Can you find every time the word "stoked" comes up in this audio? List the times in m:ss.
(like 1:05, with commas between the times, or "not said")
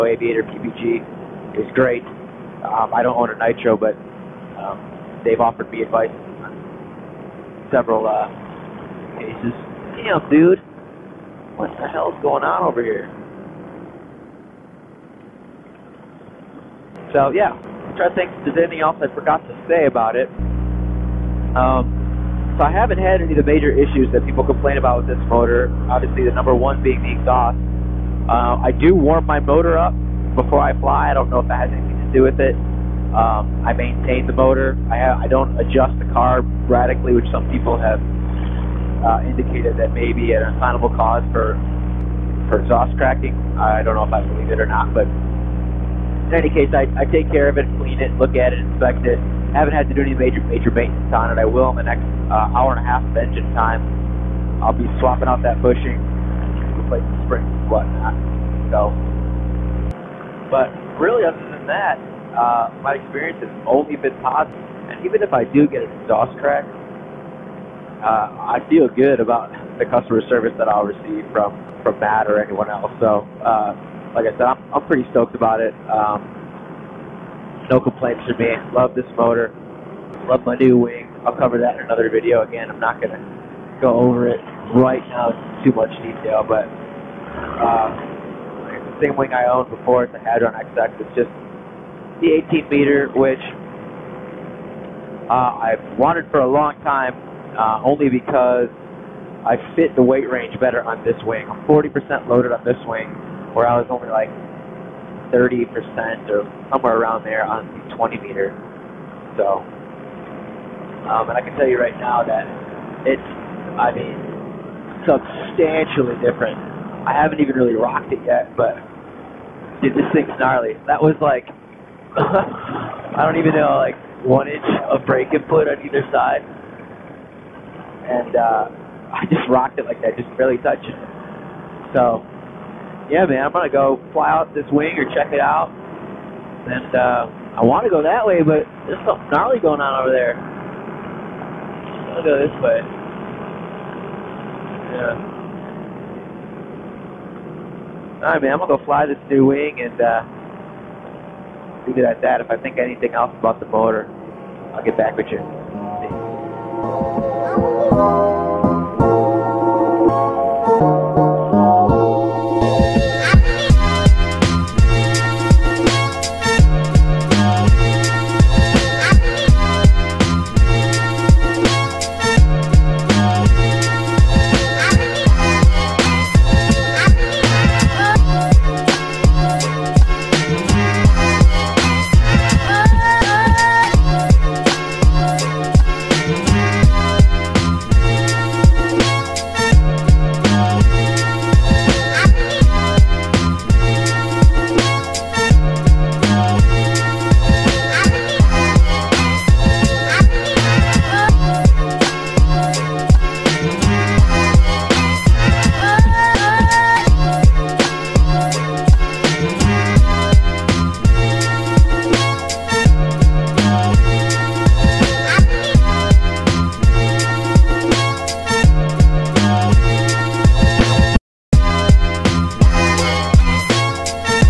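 1:15.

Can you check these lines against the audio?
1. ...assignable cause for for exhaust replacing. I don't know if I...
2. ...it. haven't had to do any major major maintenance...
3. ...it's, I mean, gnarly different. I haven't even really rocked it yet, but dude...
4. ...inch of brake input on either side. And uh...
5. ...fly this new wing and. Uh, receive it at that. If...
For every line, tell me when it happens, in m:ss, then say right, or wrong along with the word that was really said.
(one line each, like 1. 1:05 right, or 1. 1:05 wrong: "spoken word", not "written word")
1. 0:40 wrong: "cracking", not "replacing"
2. 0:49 right
3. 1:53 wrong: "substantially", not "gnarly"
4. 2:04 right
5. 2:28 wrong: "leave", not "receive".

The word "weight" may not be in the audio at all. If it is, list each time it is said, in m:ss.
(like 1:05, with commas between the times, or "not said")
1:40.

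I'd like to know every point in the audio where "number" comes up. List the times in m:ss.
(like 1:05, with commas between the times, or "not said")
0:26.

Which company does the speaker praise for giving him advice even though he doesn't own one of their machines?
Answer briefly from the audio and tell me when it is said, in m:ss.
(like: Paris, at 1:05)
Aviator PPG, at 0:00.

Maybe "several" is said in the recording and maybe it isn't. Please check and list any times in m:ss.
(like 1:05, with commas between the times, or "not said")
0:07.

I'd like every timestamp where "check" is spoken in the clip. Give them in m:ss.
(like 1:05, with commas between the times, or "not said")
2:15.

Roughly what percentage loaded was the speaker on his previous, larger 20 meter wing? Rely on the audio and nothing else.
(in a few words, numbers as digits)
30%.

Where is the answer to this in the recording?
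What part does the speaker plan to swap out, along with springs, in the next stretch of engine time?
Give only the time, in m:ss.
0:55.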